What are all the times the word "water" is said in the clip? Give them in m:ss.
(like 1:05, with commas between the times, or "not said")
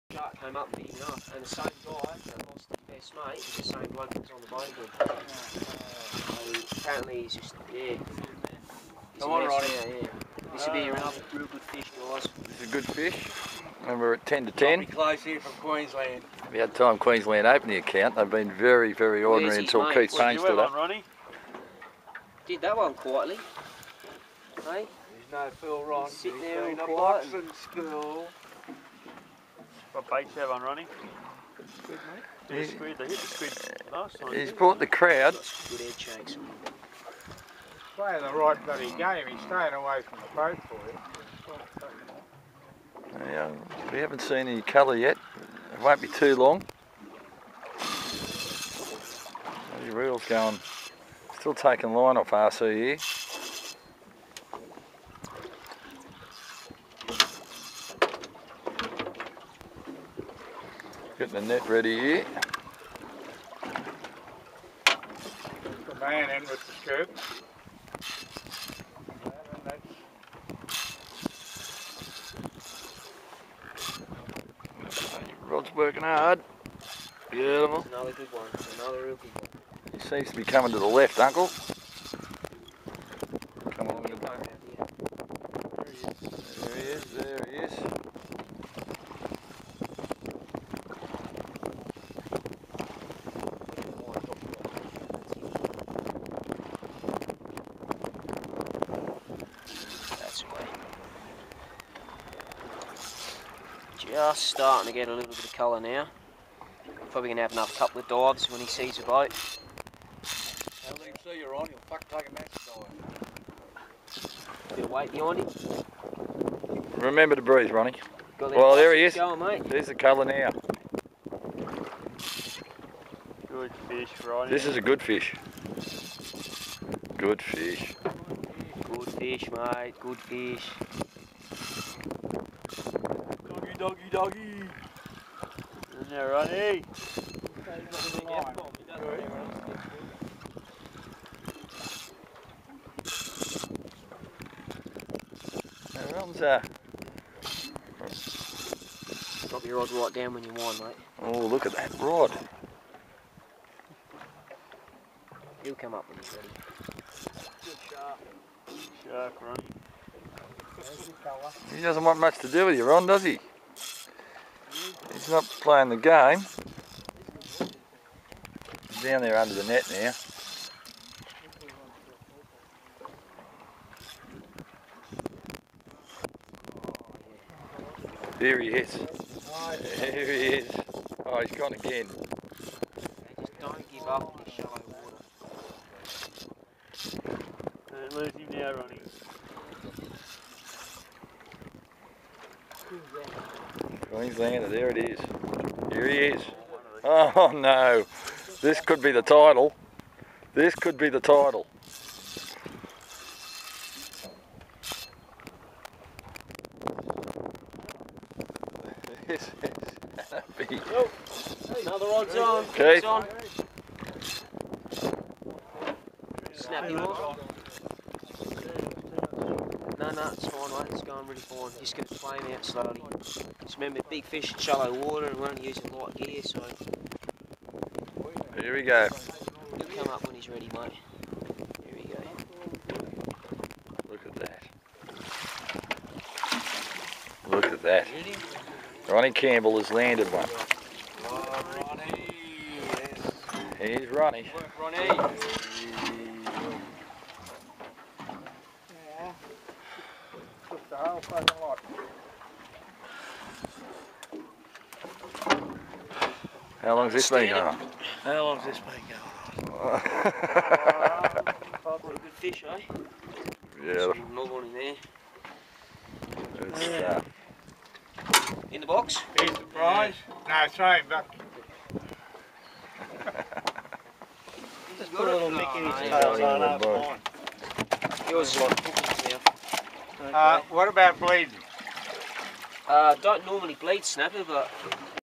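3:04, 3:45.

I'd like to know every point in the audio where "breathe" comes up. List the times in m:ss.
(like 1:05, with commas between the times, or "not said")
1:57.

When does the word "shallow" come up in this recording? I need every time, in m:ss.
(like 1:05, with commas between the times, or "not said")
3:04, 3:44.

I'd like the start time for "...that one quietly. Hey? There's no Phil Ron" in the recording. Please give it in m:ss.
0:22.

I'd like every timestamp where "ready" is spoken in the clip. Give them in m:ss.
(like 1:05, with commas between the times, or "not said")
1:01, 2:36, 3:50.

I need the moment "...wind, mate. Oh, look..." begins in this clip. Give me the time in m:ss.
2:30.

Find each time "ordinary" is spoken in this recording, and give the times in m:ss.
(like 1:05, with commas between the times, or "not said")
0:19.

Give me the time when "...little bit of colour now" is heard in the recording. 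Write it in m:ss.
1:45.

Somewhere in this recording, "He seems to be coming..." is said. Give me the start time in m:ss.
1:19.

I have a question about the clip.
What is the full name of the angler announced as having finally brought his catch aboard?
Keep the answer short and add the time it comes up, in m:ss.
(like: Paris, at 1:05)
Ronnie Campbell, at 3:59.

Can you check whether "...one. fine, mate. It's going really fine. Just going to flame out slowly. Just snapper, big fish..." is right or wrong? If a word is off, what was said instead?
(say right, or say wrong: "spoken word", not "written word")
wrong: "remember", not "snapper".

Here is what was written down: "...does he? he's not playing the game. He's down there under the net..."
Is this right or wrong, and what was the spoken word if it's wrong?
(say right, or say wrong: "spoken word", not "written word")
right.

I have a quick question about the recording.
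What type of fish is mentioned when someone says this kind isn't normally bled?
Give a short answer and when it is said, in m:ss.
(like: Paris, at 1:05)
Snapper, at 4:44.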